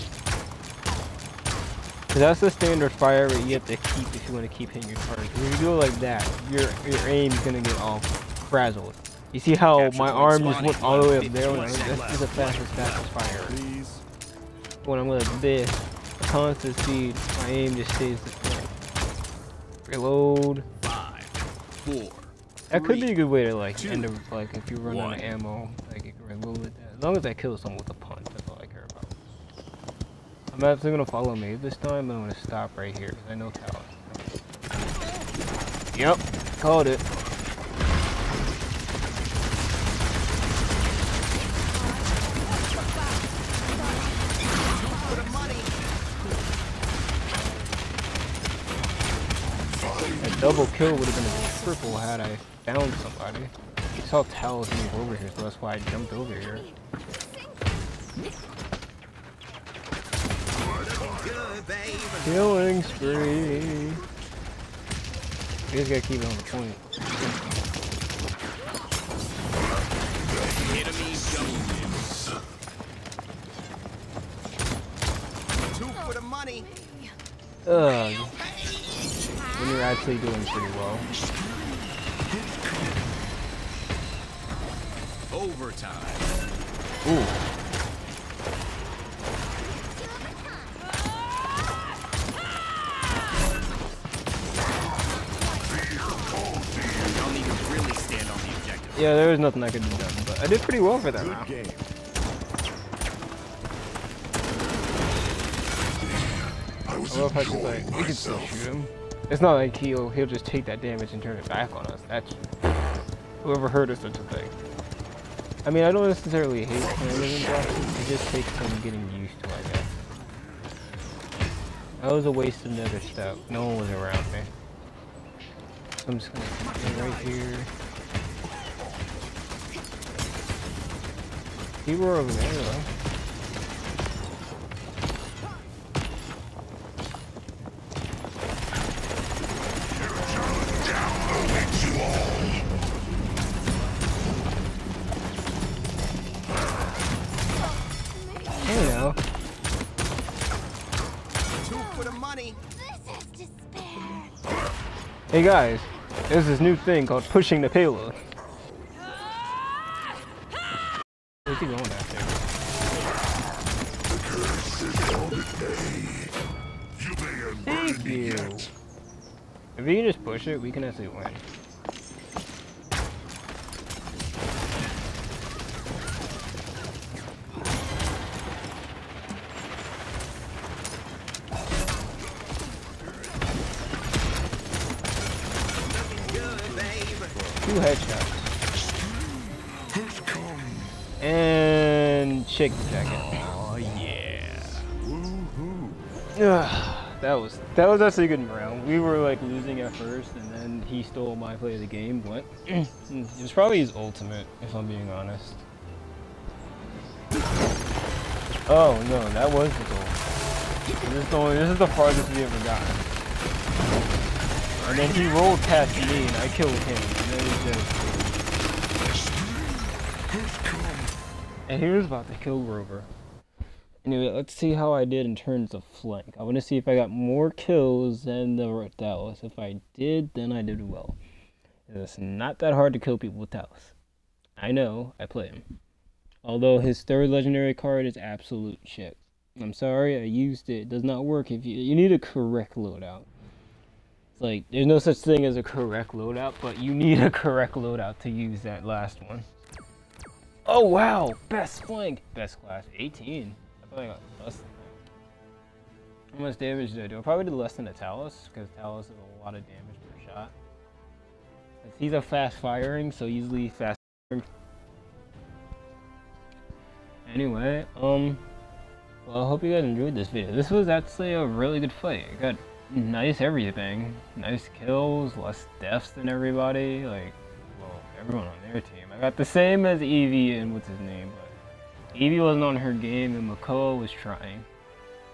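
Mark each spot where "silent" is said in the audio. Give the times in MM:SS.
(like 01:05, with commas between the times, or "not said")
not said.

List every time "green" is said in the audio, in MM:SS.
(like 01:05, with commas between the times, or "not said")
not said.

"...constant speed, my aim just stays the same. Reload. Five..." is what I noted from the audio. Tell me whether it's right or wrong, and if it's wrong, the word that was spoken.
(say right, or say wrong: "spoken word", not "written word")
right.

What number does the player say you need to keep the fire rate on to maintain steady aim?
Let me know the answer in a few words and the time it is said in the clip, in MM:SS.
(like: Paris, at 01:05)
20, at 01:06.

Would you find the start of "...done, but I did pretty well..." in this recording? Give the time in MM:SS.
01:39.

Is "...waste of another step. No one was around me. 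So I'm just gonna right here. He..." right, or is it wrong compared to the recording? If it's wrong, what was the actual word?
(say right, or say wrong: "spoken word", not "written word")
right.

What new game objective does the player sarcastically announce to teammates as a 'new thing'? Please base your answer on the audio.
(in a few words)
pushing the payload.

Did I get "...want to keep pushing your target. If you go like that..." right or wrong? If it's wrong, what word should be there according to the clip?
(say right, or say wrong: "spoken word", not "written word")
wrong: "hitting", not "pushing".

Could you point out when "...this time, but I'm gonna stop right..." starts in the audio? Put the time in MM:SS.
00:31.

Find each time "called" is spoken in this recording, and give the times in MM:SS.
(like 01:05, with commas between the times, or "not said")
00:36, 02:37.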